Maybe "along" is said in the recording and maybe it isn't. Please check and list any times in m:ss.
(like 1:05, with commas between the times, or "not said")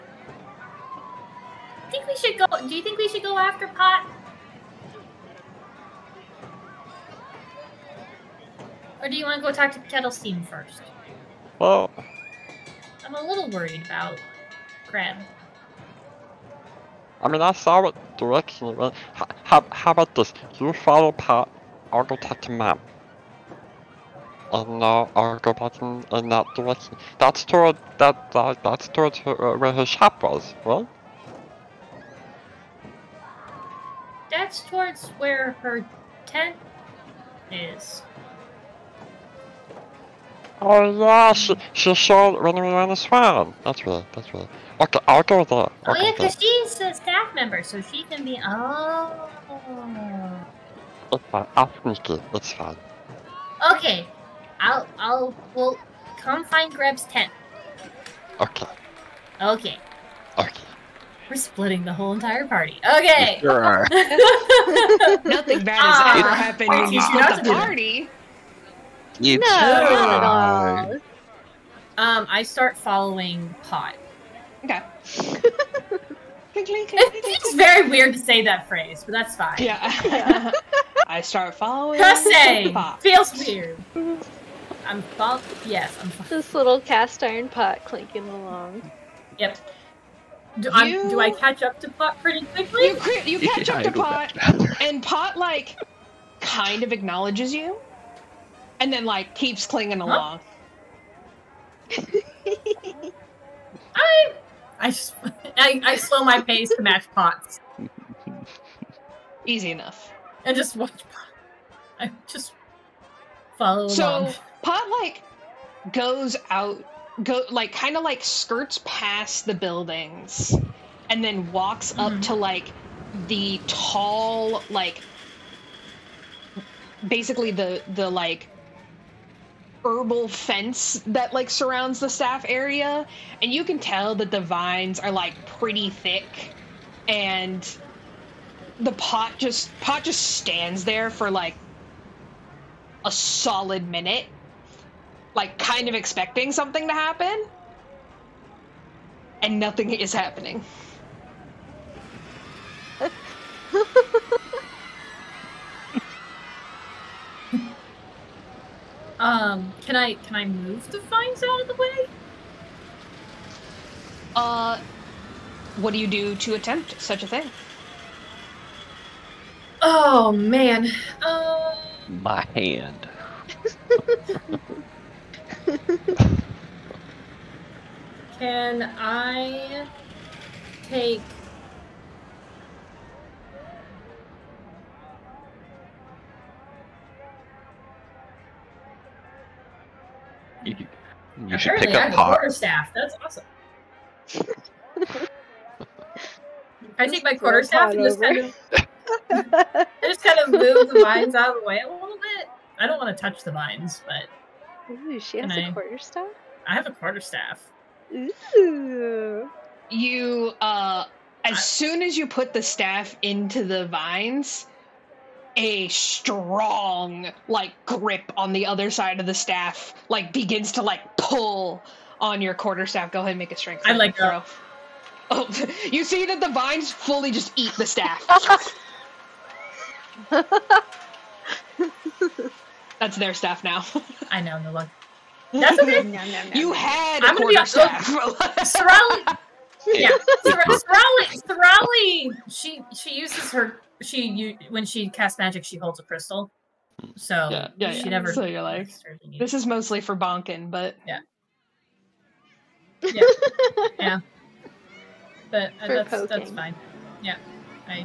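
1:28, 1:40, 1:54.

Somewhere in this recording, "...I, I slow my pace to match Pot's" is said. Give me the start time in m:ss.
1:45.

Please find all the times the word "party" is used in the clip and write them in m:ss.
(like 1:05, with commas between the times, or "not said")
1:02, 1:07.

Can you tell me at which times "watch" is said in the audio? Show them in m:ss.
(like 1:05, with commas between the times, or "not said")
1:50.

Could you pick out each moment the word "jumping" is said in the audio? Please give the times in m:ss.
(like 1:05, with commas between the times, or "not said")
not said.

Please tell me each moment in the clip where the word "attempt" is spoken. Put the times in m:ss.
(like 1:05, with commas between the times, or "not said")
2:46.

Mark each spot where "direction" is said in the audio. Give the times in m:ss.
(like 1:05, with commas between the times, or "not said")
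0:18, 0:26.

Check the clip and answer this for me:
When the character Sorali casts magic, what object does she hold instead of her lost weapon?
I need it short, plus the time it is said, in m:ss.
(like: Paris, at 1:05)
a crystal, at 4:05.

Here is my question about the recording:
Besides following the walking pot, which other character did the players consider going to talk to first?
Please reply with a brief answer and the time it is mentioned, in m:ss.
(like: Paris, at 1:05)
Kettlesteam, at 0:09.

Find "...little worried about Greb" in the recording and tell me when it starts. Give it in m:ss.
0:13.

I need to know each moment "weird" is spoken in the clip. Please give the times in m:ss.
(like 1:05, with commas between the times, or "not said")
1:17, 1:23.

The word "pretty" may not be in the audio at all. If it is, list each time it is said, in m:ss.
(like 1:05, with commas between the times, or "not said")
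1:32, 2:15.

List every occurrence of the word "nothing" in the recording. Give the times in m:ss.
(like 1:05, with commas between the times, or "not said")
1:05, 2:29.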